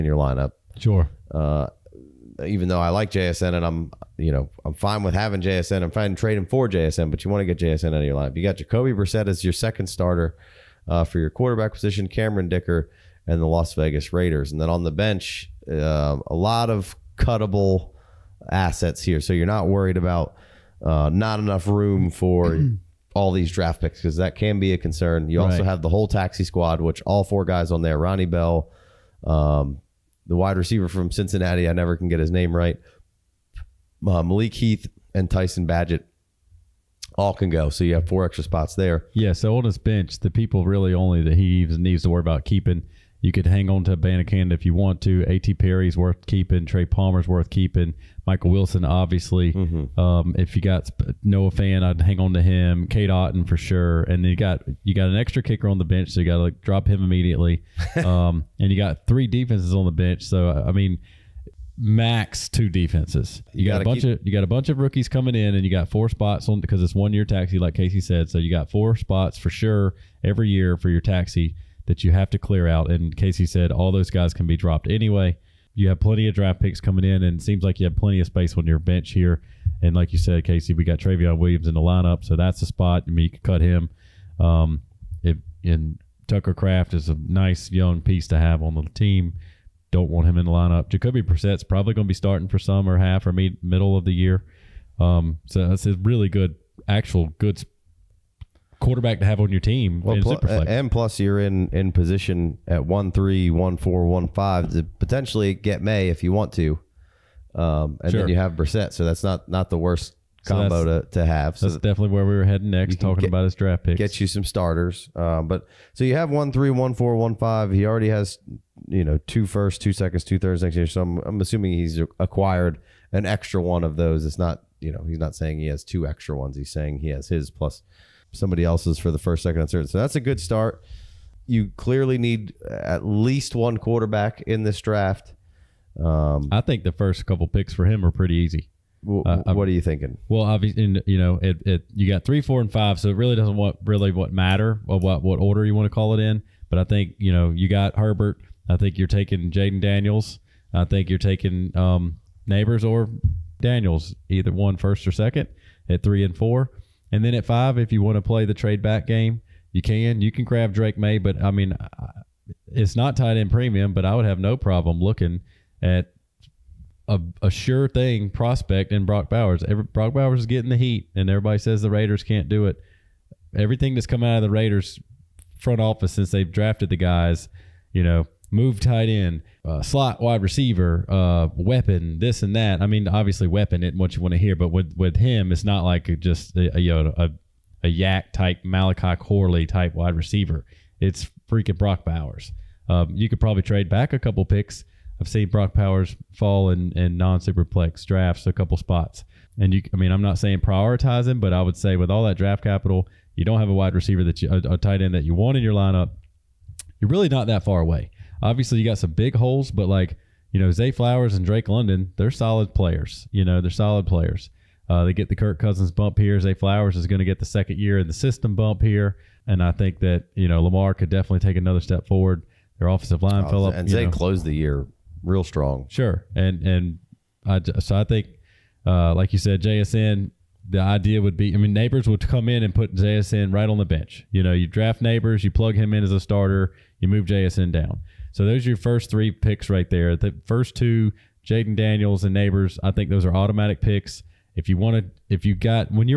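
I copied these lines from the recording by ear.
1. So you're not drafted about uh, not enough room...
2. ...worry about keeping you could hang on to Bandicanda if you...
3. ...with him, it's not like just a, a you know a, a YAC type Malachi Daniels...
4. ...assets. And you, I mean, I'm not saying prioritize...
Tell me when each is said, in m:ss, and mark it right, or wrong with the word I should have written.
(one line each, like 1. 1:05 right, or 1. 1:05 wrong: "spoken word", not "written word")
1. 0:19 wrong: "worried", not "drafted"
2. 0:42 right
3. 3:04 wrong: "Corley", not "Daniels"
4. 3:18 wrong: "spots", not "assets".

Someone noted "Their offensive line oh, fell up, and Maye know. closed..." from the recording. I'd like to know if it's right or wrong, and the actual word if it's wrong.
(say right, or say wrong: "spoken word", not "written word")
wrong: "Zay", not "Maye".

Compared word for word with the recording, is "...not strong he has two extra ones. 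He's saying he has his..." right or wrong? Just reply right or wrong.
wrong.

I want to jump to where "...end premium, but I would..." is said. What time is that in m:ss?
2:43.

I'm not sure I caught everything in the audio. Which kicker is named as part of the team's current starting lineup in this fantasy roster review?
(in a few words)
Cameron Dicker.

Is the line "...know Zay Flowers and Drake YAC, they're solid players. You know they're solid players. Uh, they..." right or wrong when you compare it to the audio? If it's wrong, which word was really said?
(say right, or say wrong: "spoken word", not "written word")
wrong: "London", not "YAC".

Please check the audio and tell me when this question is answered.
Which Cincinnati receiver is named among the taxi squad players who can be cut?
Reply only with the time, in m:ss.
0:27.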